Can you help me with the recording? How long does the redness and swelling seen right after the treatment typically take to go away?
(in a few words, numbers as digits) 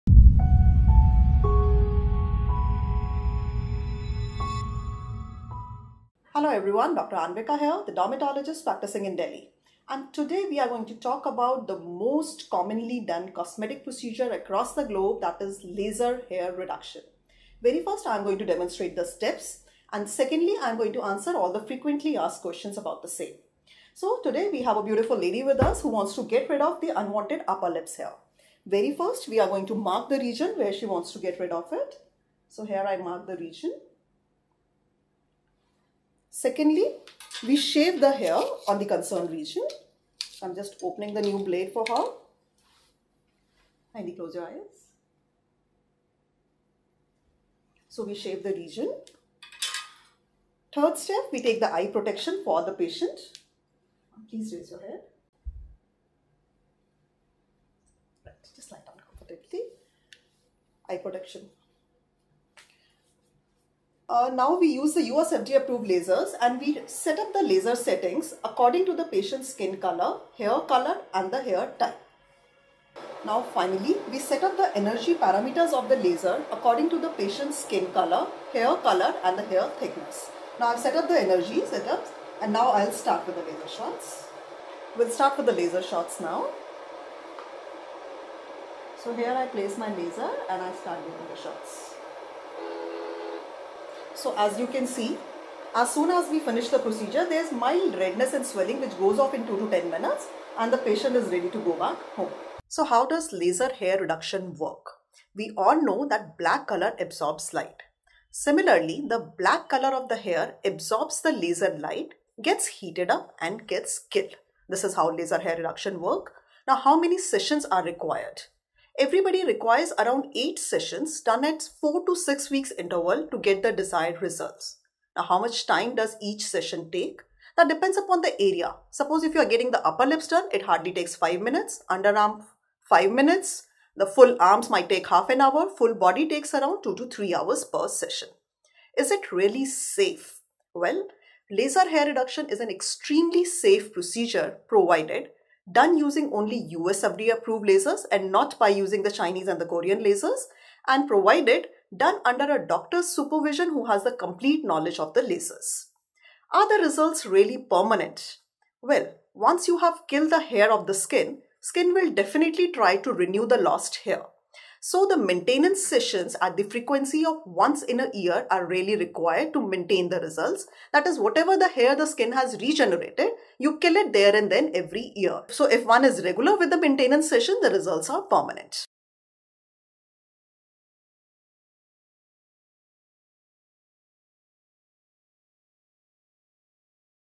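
2 to 10 minutes.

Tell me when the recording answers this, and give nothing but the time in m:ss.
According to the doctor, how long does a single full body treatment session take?
2:16.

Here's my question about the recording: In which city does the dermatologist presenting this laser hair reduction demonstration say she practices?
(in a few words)
Delhi.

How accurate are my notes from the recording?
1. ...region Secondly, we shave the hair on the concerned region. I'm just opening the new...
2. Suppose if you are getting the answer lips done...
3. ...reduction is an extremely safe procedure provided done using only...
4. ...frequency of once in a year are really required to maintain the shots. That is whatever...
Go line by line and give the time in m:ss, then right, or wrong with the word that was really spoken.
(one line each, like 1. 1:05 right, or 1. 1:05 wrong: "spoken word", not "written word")
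1. 0:33 right
2. 2:08 wrong: "upper", not "answer"
3. 2:22 right
4. 2:46 wrong: "results", not "shots".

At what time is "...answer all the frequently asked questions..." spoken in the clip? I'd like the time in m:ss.
0:21.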